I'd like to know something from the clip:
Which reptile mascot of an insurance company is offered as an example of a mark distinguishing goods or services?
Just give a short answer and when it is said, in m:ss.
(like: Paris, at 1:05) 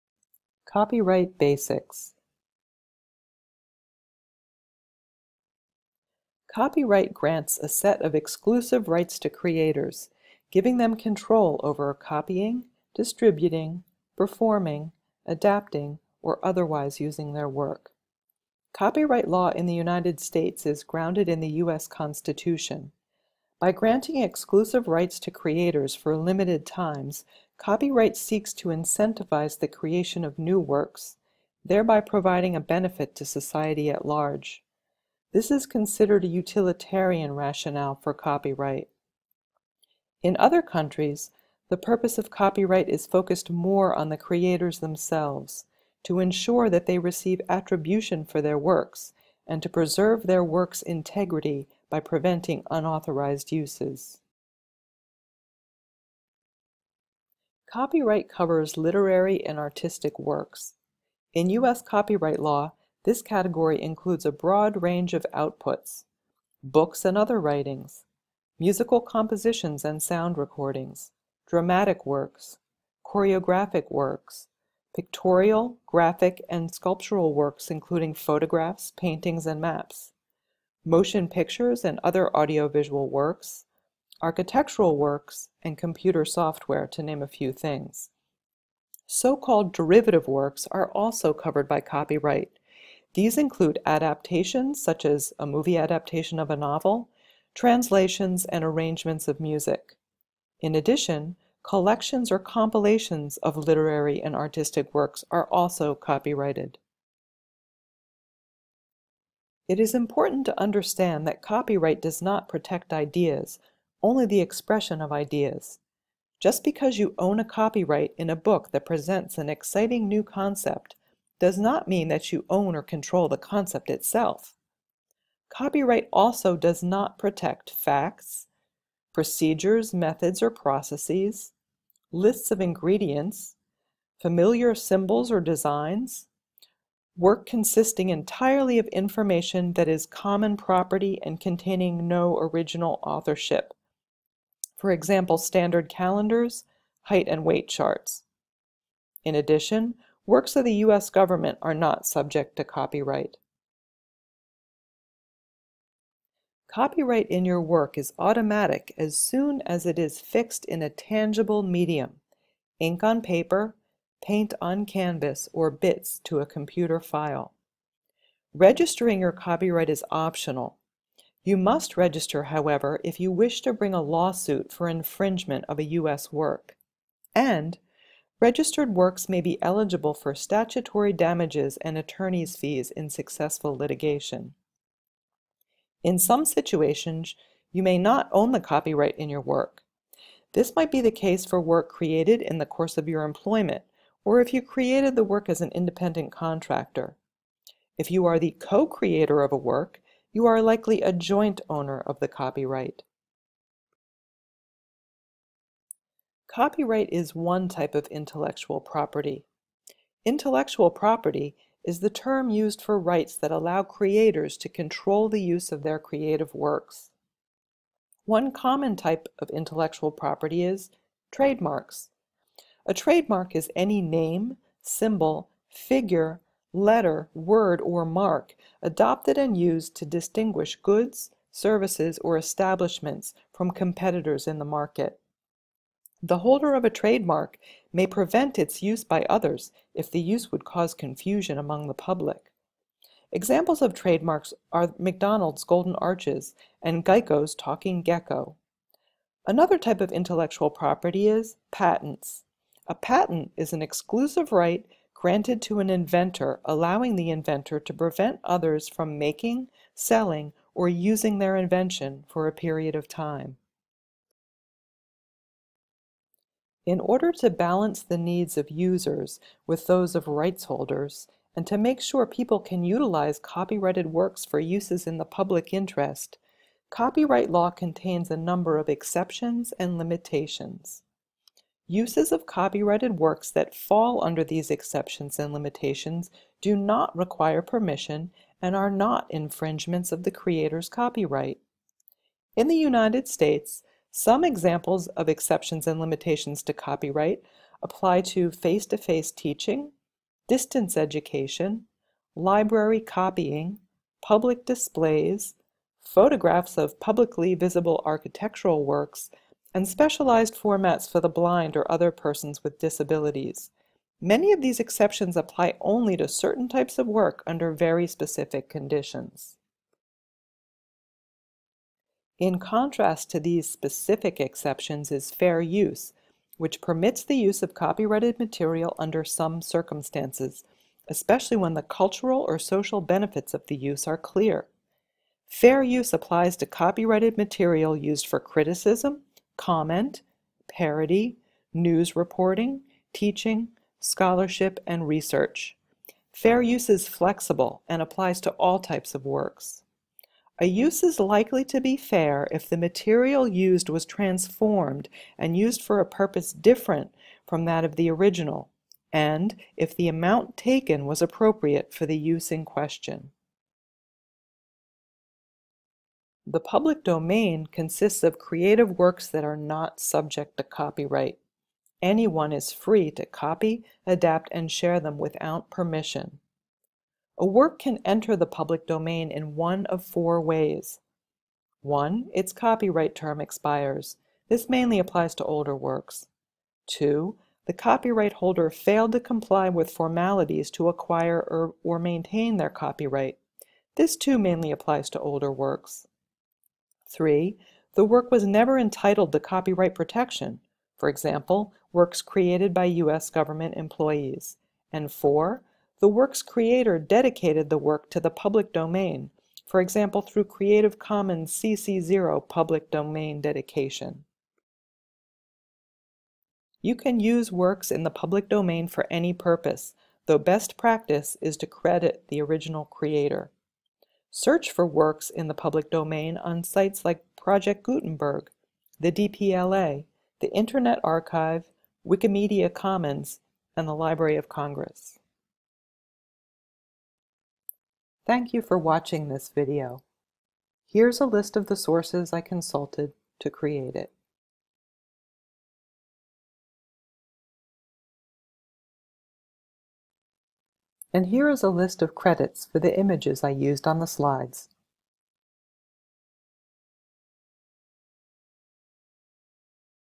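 Geico's Talking Gecko, at 4:07.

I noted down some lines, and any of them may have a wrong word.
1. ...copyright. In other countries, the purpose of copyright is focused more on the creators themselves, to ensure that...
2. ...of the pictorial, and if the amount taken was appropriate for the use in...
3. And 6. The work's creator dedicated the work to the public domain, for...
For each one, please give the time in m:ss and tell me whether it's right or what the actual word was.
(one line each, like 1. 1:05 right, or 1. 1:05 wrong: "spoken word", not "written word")
1. 0:38 right
2. 5:57 wrong: "original", not "pictorial"
3. 6:44 wrong: "4", not "6".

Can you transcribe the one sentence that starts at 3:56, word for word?
The holder of a trademark may prevent its use by others if the use would cause confusion among the public.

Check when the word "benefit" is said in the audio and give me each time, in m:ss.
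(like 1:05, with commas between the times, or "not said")
0:32, 5:33.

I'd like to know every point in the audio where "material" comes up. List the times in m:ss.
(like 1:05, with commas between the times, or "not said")
5:28, 5:37, 5:52.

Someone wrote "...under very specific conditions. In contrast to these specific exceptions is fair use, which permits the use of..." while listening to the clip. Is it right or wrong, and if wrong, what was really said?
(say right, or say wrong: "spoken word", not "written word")
right.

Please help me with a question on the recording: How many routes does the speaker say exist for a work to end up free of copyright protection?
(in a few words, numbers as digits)
4.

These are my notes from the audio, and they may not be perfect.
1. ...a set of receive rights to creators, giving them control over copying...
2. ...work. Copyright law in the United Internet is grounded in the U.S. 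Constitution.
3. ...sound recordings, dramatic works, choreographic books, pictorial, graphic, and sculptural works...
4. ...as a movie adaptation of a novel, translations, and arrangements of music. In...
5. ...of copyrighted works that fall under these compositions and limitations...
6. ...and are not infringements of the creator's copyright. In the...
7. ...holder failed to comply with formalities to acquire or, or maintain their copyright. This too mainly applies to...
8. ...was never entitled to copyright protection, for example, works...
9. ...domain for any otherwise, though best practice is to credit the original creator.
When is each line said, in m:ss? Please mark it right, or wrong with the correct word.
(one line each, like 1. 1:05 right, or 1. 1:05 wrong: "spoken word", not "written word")
1. 0:07 wrong: "exclusive", not "receive"
2. 0:17 wrong: "States", not "Internet"
3. 1:10 wrong: "works", not "books"
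4. 1:35 right
5. 4:42 wrong: "exceptions", not "compositions"
6. 4:48 right
7. 6:28 right
8. 6:38 right
9. 6:58 wrong: "purpose", not "otherwise".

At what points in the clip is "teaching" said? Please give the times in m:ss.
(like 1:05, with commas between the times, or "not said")
4:59, 5:43.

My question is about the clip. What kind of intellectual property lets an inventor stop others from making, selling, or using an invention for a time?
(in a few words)
patents.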